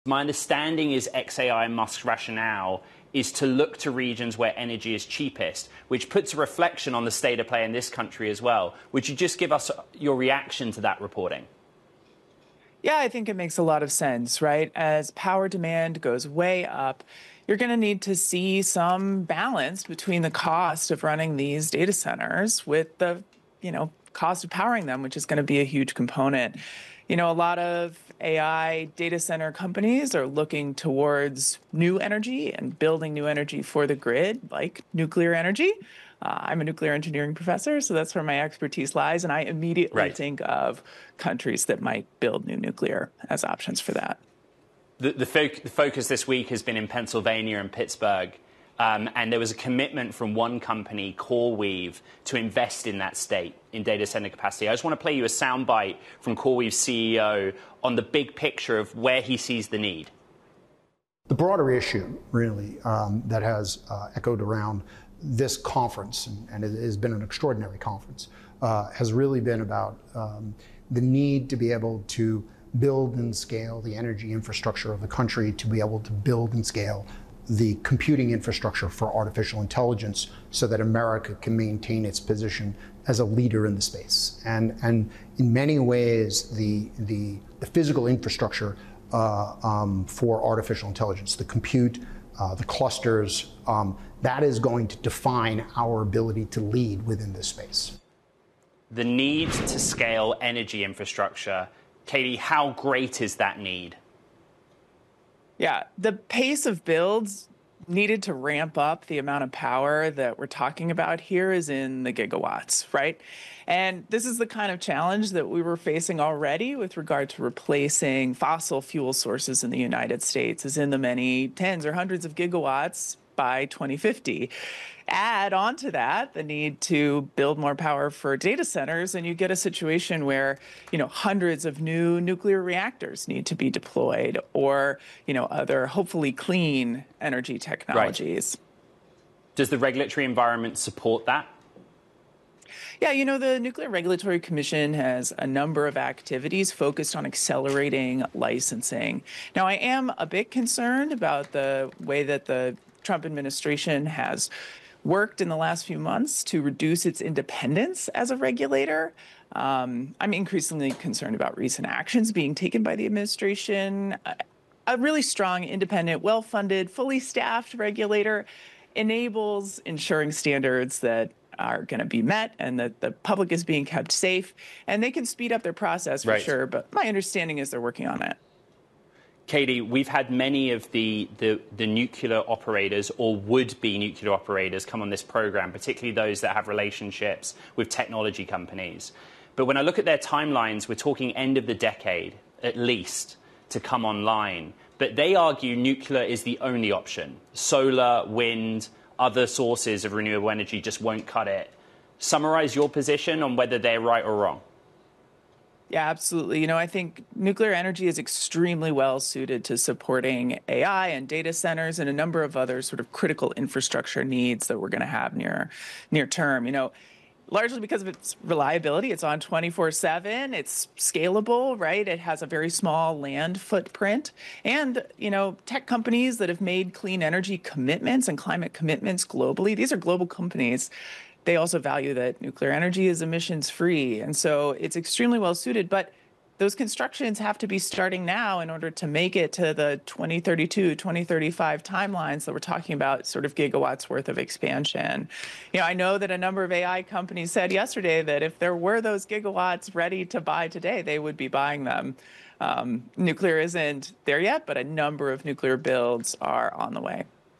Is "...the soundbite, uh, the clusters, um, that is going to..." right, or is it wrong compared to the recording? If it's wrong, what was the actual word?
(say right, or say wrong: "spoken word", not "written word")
wrong: "compute", not "soundbite".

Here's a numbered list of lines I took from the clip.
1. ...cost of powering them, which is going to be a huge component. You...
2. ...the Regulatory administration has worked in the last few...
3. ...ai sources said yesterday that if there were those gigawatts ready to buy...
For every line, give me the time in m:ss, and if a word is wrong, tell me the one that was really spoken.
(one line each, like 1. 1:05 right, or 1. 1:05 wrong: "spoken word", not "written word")
1. 0:24 right
2. 2:32 wrong: "Trump", not "Regulatory"
3. 4:06 wrong: "companies", not "sources".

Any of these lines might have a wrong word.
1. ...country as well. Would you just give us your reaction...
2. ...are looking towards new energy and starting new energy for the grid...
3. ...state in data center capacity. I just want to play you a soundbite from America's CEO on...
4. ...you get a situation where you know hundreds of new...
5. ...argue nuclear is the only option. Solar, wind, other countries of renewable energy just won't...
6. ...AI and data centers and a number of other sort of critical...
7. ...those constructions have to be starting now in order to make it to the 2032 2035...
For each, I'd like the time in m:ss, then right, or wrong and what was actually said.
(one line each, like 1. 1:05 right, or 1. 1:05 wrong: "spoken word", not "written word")
1. 0:07 right
2. 0:30 wrong: "building", not "starting"
3. 0:53 wrong: "CoreWeave", not "America"
4. 2:09 right
5. 3:15 wrong: "sources", not "countries"
6. 3:30 right
7. 3:56 right.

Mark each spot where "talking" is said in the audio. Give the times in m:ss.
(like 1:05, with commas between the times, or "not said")
1:50, 3:10, 4:02.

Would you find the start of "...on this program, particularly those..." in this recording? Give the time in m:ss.
3:05.